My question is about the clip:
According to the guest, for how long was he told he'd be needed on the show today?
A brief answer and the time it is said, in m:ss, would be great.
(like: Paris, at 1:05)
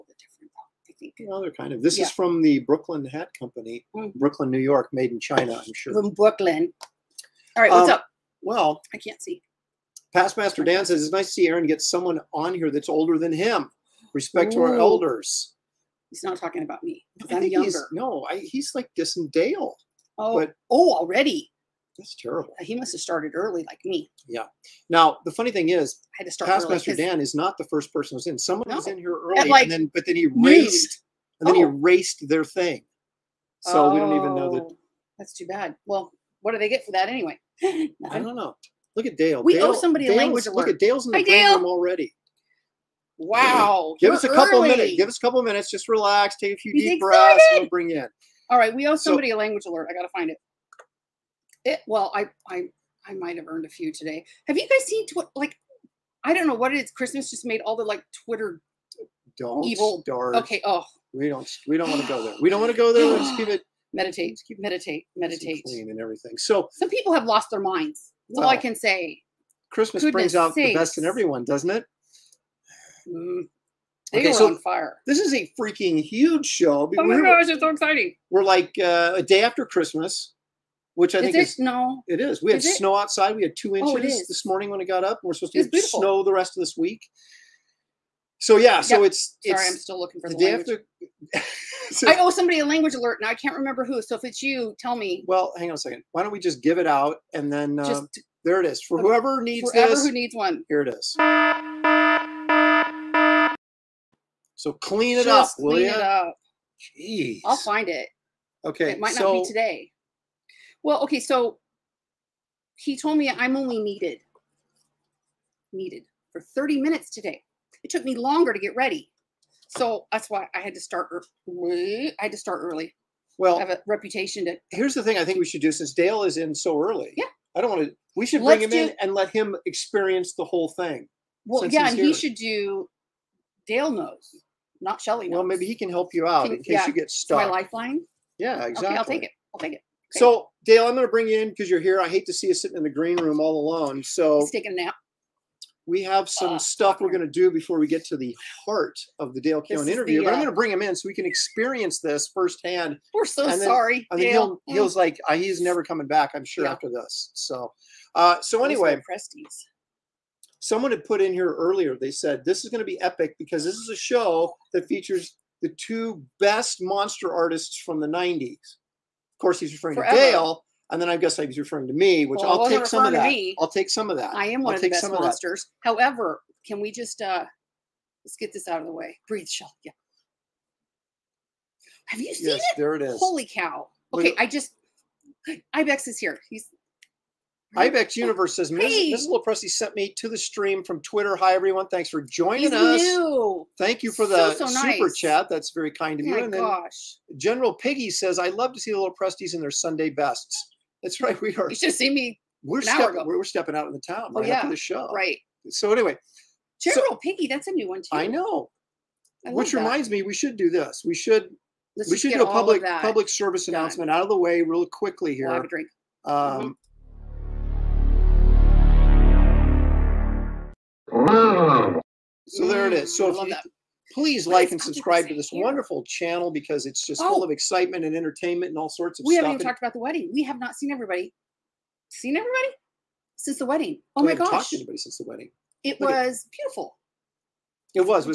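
30 minutes, at 1:56.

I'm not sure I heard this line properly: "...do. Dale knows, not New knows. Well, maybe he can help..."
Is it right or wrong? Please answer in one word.
wrong.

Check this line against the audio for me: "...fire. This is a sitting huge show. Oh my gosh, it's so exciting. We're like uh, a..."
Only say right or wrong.
wrong.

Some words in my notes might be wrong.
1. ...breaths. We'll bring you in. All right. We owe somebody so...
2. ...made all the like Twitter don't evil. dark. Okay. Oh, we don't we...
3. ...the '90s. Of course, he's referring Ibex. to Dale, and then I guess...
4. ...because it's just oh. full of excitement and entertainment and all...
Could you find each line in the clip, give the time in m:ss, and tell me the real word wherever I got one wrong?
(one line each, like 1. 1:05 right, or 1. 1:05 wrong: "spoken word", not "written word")
1. 0:46 right
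2. 0:57 right
3. 2:47 wrong: "Forever", not "Ibex"
4. 3:46 right.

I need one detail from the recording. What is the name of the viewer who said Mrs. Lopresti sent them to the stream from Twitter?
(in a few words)
Ibex Universe.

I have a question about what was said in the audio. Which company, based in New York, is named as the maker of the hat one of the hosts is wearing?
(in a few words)
Brooklyn Hat Company.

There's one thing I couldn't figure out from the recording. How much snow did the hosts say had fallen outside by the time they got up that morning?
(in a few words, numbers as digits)
2 inches.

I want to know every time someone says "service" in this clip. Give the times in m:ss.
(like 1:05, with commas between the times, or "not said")
3:33.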